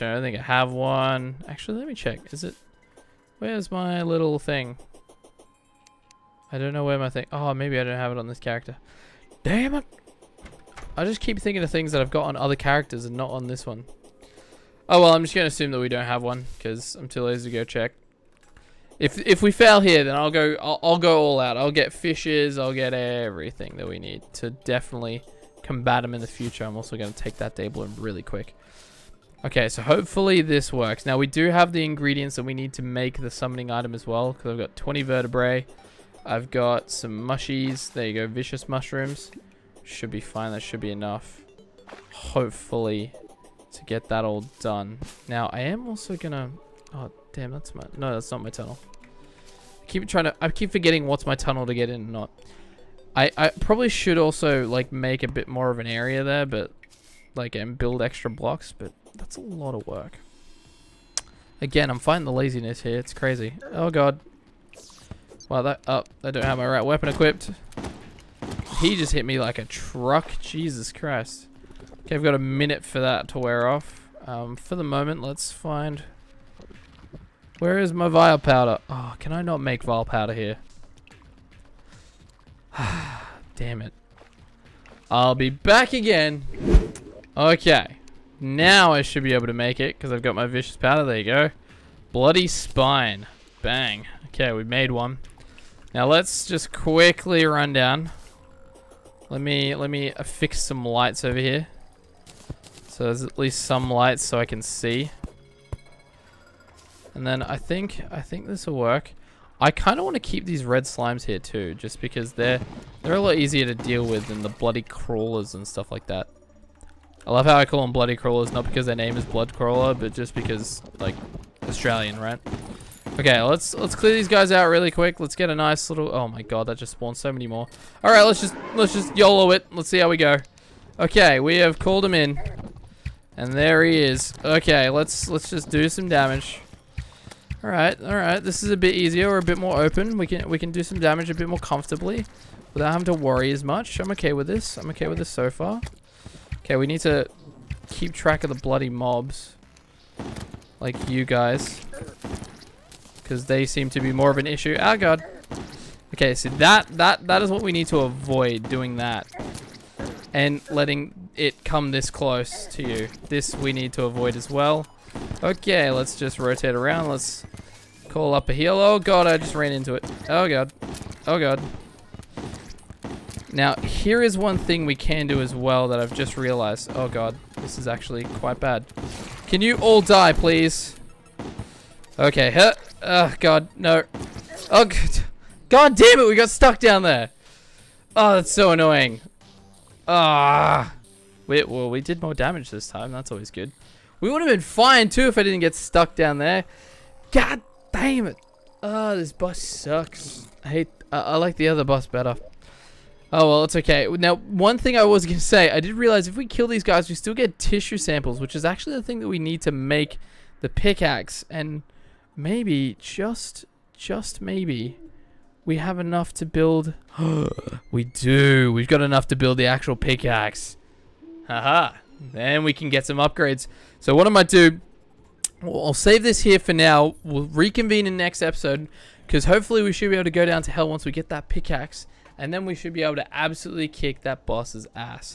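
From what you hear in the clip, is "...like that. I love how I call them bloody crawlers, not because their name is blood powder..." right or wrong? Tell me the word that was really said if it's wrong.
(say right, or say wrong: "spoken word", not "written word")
wrong: "crawler", not "powder".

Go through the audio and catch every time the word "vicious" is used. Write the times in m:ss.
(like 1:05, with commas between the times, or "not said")
0:38, 1:30.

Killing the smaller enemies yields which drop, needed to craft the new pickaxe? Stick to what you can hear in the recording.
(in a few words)
tissue samples.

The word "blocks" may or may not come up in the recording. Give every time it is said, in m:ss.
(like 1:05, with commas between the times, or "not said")
0:58.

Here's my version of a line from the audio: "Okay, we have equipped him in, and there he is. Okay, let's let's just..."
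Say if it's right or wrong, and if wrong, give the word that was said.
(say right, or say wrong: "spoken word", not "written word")
wrong: "called", not "equipped".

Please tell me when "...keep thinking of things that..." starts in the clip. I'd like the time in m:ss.
0:11.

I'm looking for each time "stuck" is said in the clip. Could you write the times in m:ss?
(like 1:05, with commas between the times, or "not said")
3:06, 3:15.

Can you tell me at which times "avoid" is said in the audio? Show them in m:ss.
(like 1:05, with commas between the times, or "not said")
2:37, 2:44.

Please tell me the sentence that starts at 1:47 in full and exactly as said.
And then I think I think this will work.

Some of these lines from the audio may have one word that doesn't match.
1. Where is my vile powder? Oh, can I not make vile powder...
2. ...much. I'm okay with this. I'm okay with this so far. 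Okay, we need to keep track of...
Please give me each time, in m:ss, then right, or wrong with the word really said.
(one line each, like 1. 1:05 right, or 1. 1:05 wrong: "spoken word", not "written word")
1. 1:17 right
2. 2:23 right.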